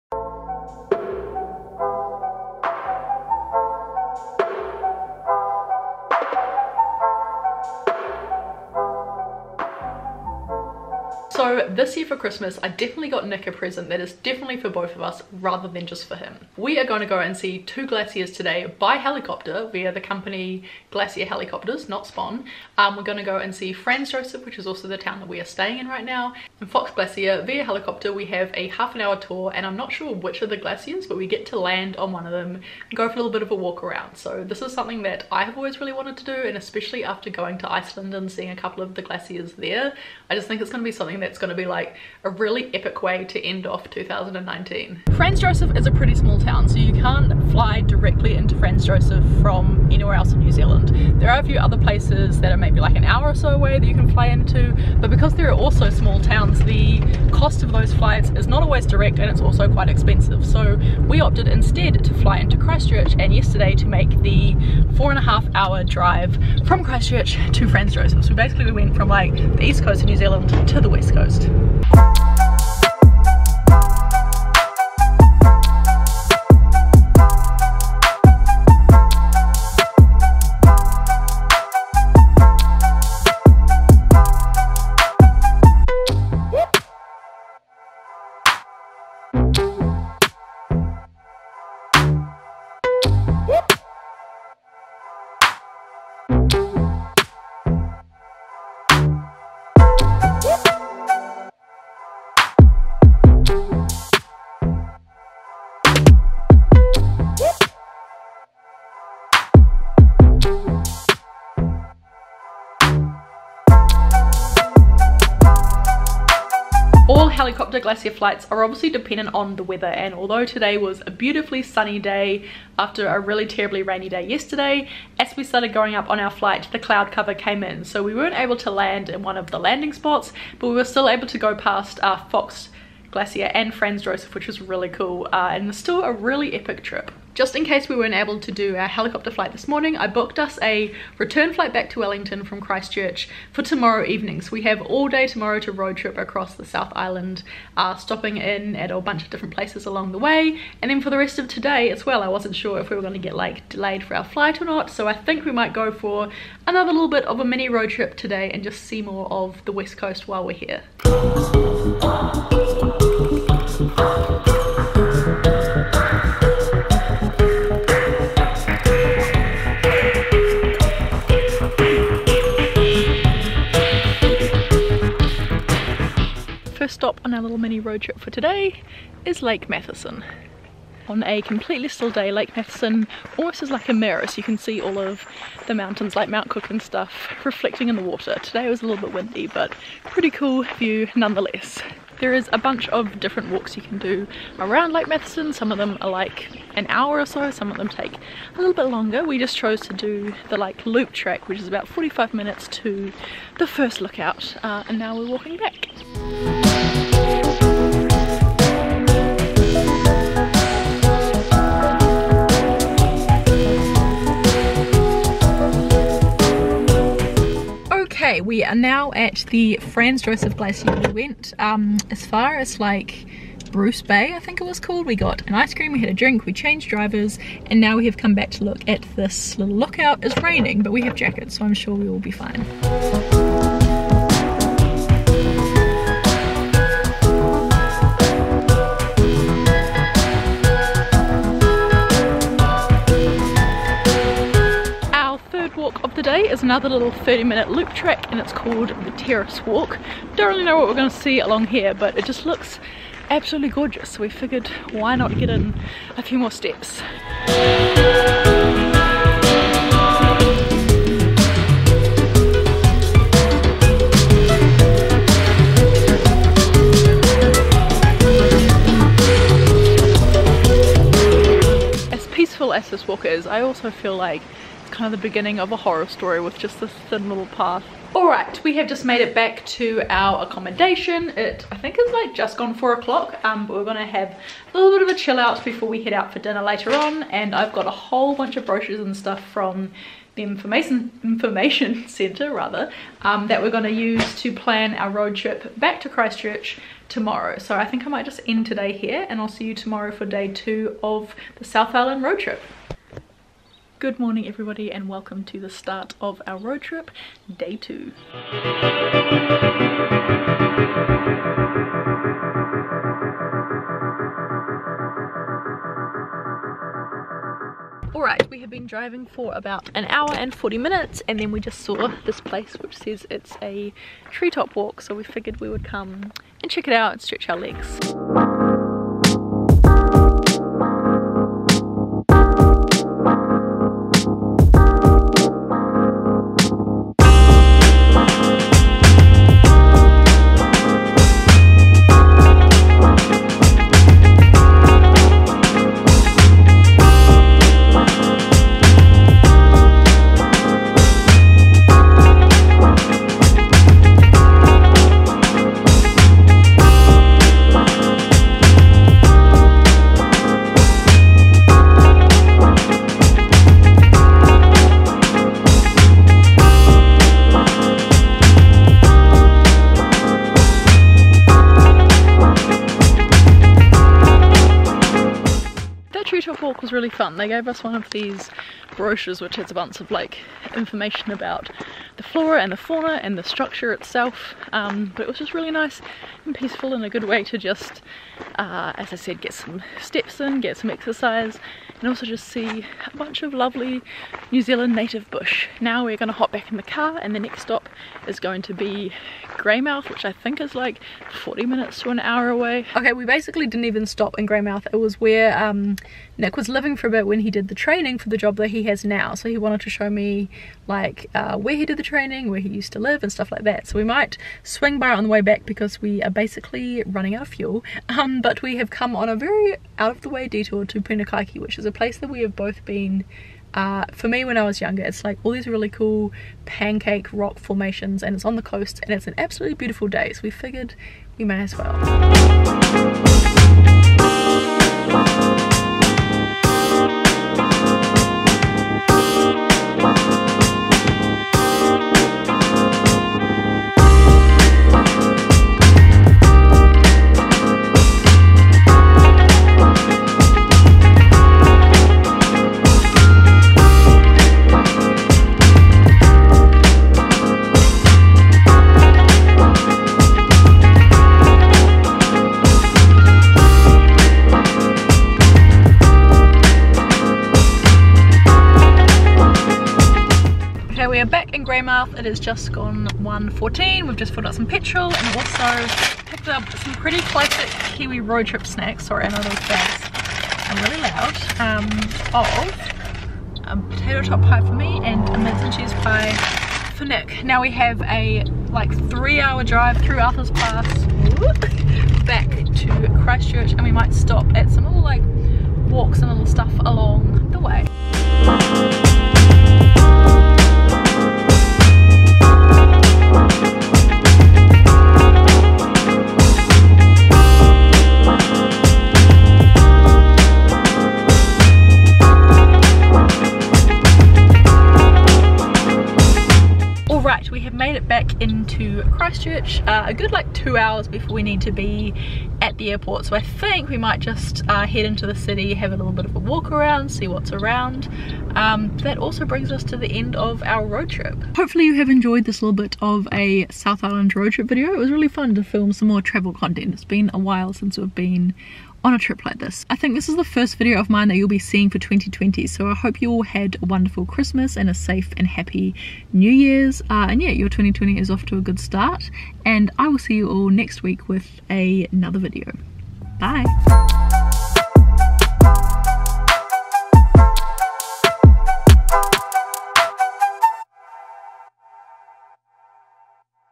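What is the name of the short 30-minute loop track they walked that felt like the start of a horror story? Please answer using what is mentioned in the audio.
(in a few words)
Terrace Walk.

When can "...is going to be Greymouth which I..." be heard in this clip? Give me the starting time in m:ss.
6:38.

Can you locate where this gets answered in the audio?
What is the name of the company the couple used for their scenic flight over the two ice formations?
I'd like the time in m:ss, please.
0:20.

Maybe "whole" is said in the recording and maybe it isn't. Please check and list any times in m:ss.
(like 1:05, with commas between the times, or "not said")
4:47.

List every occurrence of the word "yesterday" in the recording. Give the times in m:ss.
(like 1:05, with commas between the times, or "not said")
1:03, 2:04.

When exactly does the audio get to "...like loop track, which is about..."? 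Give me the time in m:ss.
3:20.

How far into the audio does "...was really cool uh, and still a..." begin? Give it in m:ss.
2:14.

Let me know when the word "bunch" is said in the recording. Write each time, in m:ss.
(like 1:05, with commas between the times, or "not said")
2:28, 3:12, 4:48, 6:19, 6:33.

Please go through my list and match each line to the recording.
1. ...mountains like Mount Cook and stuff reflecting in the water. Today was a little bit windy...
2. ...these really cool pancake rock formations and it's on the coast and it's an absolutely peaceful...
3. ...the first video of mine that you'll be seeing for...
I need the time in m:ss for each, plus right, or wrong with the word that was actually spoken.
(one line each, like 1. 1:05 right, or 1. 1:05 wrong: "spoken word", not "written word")
1. 3:05 right
2. 7:05 wrong: "beautiful", not "peaceful"
3. 9:00 right.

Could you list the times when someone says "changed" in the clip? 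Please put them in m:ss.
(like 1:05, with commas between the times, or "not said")
3:46.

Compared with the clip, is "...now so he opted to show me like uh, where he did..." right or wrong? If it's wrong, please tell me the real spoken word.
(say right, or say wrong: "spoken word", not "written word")
wrong: "wanted", not "opted".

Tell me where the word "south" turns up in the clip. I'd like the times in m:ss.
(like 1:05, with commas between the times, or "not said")
2:26, 5:01, 7:52, 8:53.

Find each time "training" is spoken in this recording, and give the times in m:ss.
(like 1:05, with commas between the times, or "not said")
6:47, 6:52.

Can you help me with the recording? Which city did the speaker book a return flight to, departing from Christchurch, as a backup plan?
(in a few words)
Wellington.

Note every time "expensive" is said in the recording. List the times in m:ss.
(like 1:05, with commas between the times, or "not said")
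0:59.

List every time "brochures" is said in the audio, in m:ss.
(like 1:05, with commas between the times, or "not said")
4:48, 6:18.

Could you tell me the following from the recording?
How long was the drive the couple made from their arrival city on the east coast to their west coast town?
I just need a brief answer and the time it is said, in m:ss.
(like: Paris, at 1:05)
4.5 hours, at 1:04.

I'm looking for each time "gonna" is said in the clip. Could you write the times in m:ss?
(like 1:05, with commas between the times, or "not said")
2:33, 4:43.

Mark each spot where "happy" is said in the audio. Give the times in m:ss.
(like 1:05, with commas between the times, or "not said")
9:05.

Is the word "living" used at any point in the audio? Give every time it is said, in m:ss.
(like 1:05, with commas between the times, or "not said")
6:46.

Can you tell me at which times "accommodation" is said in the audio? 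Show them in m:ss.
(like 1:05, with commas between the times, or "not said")
4:40.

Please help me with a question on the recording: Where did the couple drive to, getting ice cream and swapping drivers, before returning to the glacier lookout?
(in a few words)
Bruce Bay.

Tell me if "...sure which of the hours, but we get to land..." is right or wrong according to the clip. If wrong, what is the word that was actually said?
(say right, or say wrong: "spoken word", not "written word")
wrong: "glaciers", not "hours".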